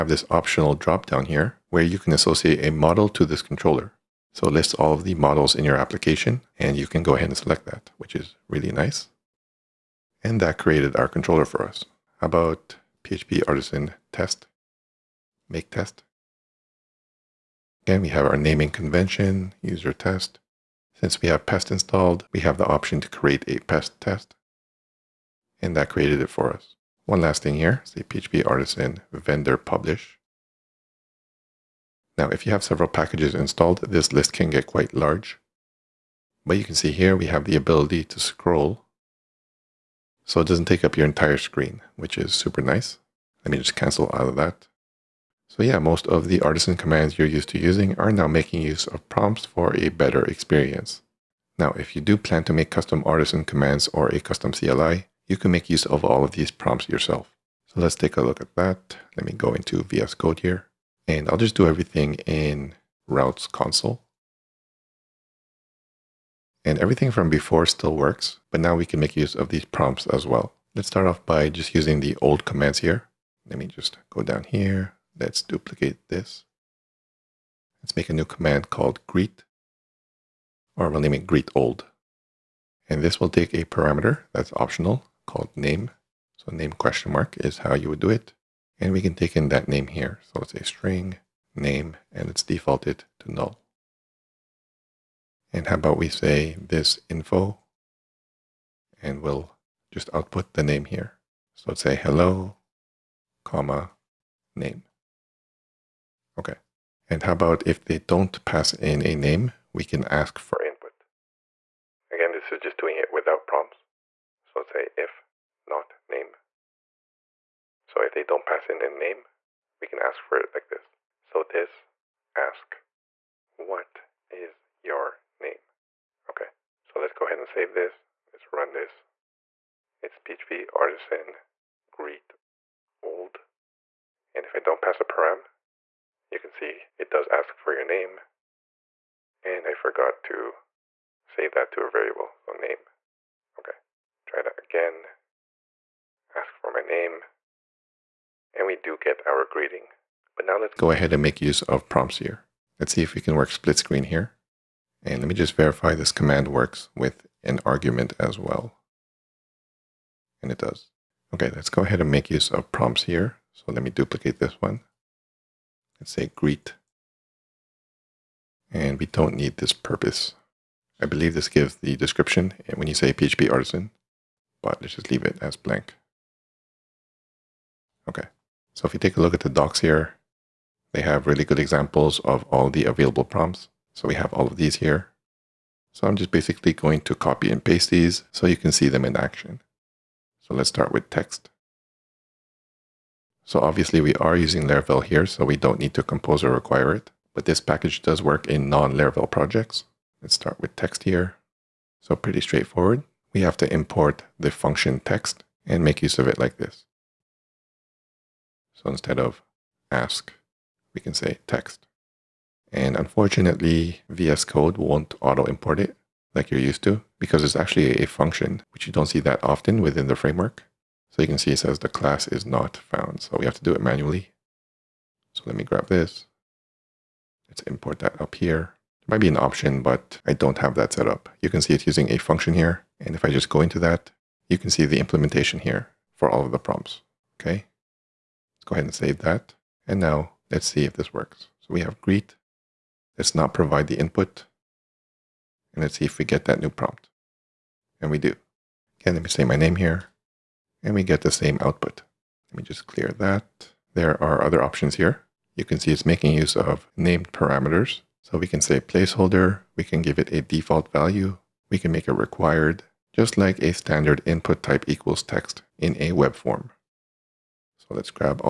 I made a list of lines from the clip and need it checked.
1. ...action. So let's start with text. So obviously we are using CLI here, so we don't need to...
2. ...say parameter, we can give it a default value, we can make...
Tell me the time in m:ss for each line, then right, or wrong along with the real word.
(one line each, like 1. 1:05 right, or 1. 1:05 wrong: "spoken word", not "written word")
1. 3:09 wrong: "Laravel", not "CLI"
2. 4:18 wrong: "placeholder", not "parameter".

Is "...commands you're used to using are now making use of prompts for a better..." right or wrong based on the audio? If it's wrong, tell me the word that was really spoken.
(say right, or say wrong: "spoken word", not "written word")
right.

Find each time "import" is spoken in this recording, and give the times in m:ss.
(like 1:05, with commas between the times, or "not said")
3:23, 3:35, 3:47.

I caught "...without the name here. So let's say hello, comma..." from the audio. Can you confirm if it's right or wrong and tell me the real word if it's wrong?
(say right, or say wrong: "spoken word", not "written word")
wrong: "output", not "without".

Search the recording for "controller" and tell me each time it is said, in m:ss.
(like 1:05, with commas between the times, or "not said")
0:03, 0:11.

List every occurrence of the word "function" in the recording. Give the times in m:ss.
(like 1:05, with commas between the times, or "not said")
3:24, 3:38, 3:52.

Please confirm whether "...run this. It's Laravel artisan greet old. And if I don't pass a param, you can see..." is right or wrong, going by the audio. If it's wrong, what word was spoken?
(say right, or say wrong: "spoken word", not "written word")
wrong: "PHP", not "Laravel".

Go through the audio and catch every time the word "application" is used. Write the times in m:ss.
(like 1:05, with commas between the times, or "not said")
0:05.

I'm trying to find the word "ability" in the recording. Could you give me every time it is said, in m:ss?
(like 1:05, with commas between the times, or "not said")
0:37.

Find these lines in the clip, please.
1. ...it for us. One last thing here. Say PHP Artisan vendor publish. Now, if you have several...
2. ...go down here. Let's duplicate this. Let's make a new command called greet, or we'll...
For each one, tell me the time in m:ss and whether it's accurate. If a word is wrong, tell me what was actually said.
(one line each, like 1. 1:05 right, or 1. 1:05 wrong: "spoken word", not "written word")
1. 0:26 right
2. 1:14 right.